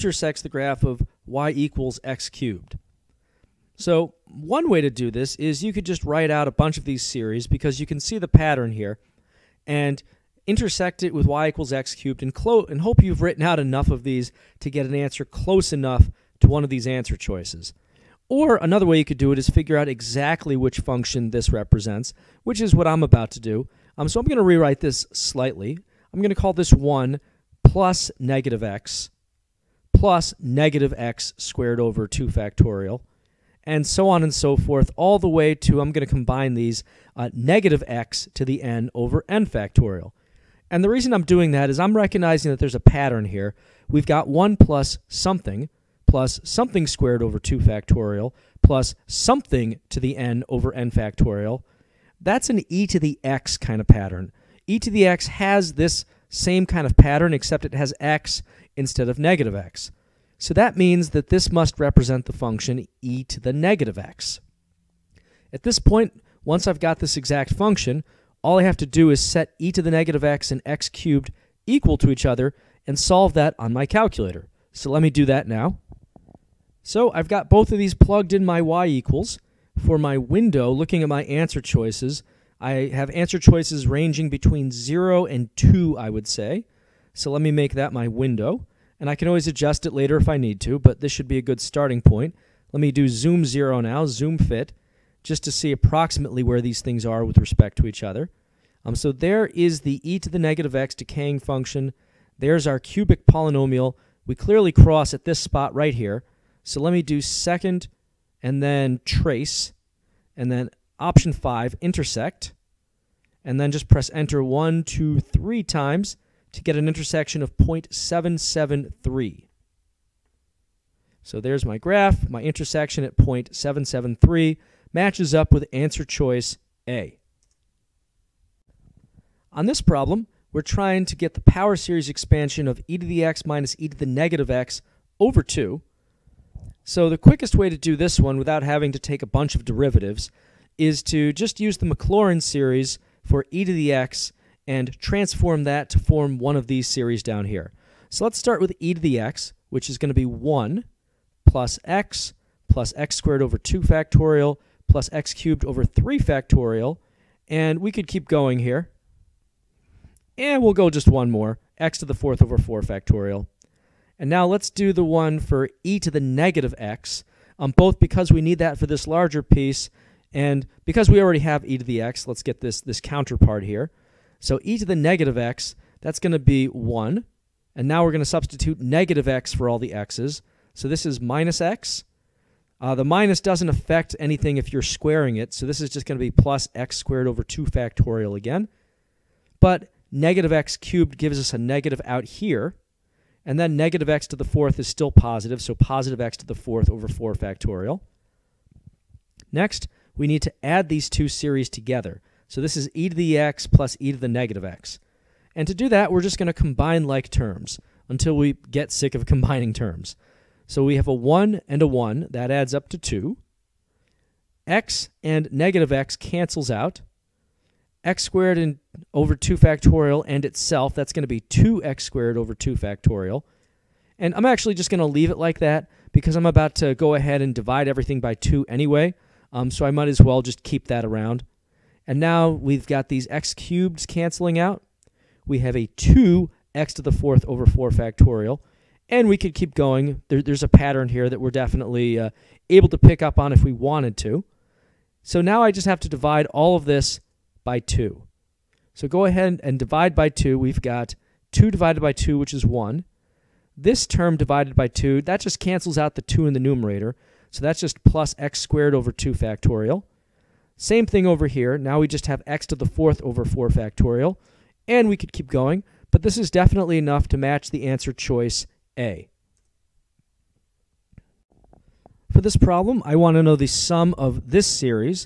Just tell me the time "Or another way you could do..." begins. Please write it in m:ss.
0:18.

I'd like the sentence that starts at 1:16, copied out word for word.
So I've got both of these plugged in my y equals.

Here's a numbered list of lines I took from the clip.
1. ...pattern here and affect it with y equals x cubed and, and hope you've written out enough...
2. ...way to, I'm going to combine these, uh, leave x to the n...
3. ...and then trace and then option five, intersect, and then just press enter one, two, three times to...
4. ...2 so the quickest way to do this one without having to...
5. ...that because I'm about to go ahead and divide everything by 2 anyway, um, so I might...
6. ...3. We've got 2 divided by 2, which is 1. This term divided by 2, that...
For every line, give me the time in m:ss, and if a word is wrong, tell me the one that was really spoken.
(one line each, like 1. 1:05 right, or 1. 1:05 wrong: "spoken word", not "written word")
1. 0:08 wrong: "intersect", not "affect"
2. 0:35 wrong: "negative", not "leave"
3. 1:48 right
4. 2:15 right
5. 3:45 right
6. 4:10 wrong: "2", not "3".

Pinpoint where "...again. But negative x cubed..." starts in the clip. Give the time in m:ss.
3:08.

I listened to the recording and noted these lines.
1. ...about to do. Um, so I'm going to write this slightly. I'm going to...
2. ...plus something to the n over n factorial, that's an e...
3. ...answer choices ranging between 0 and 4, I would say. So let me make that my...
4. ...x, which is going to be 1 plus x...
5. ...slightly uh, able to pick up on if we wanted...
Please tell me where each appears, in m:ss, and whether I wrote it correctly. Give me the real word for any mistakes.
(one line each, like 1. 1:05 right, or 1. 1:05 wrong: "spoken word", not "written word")
1. 0:23 wrong: "rewrite", not "write"
2. 0:48 right
3. 1:23 wrong: "2", not "4"
4. 2:29 right
5. 4:01 wrong: "definitely", not "slightly".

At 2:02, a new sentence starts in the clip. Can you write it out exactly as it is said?
My intersection at 0.773 matches up with answer choice A.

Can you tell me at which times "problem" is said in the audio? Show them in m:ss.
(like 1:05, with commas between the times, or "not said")
2:09, 4:32.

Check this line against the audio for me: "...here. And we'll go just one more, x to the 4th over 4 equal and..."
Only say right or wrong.
wrong.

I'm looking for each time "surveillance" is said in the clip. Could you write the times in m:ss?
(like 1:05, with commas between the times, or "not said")
not said.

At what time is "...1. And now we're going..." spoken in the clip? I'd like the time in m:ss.
2:56.